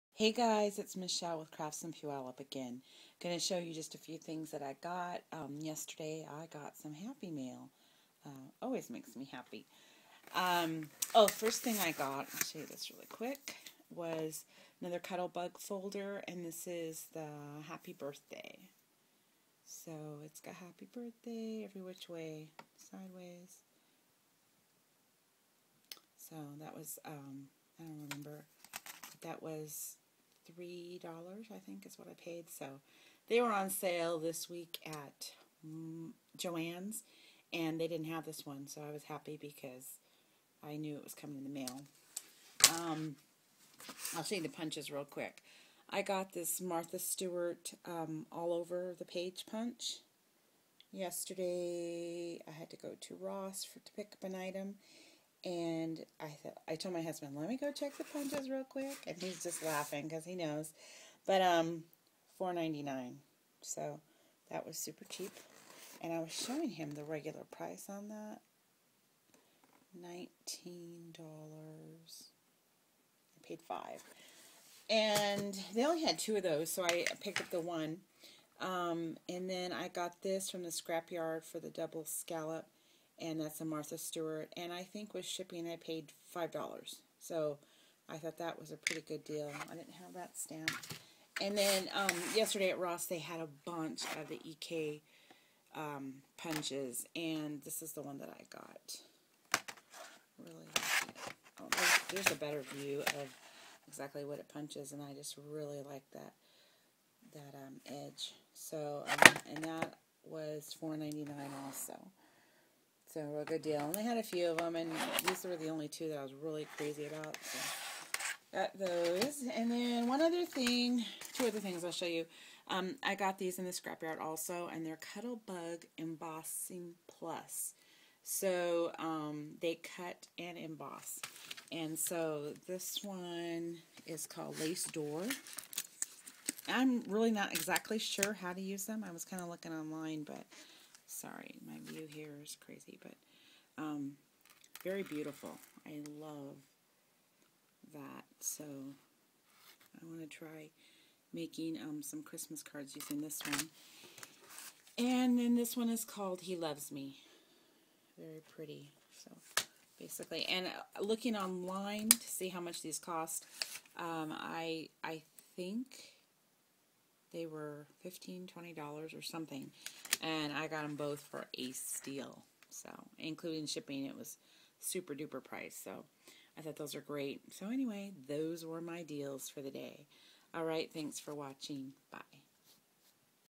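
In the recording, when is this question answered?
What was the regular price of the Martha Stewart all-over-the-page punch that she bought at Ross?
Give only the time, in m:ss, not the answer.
1:09.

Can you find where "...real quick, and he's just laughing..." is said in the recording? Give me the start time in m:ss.
0:58.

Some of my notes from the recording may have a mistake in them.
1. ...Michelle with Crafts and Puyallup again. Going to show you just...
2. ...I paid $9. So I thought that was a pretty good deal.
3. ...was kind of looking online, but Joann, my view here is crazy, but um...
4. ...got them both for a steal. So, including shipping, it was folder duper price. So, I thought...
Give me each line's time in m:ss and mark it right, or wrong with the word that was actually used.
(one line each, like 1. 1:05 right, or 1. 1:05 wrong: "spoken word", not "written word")
1. 0:00 right
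2. 1:25 wrong: "5", not "9"
3. 2:19 wrong: "Sorry", not "Joann"
4. 2:50 wrong: "super", not "folder".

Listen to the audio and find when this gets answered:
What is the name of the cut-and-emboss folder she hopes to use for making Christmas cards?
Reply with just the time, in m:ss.
2:14.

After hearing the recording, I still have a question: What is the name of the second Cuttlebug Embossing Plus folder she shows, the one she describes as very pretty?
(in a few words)
He Loves Me.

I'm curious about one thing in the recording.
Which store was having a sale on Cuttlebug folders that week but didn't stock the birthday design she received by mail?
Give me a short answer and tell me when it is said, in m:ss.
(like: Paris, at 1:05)
Joann's, at 0:36.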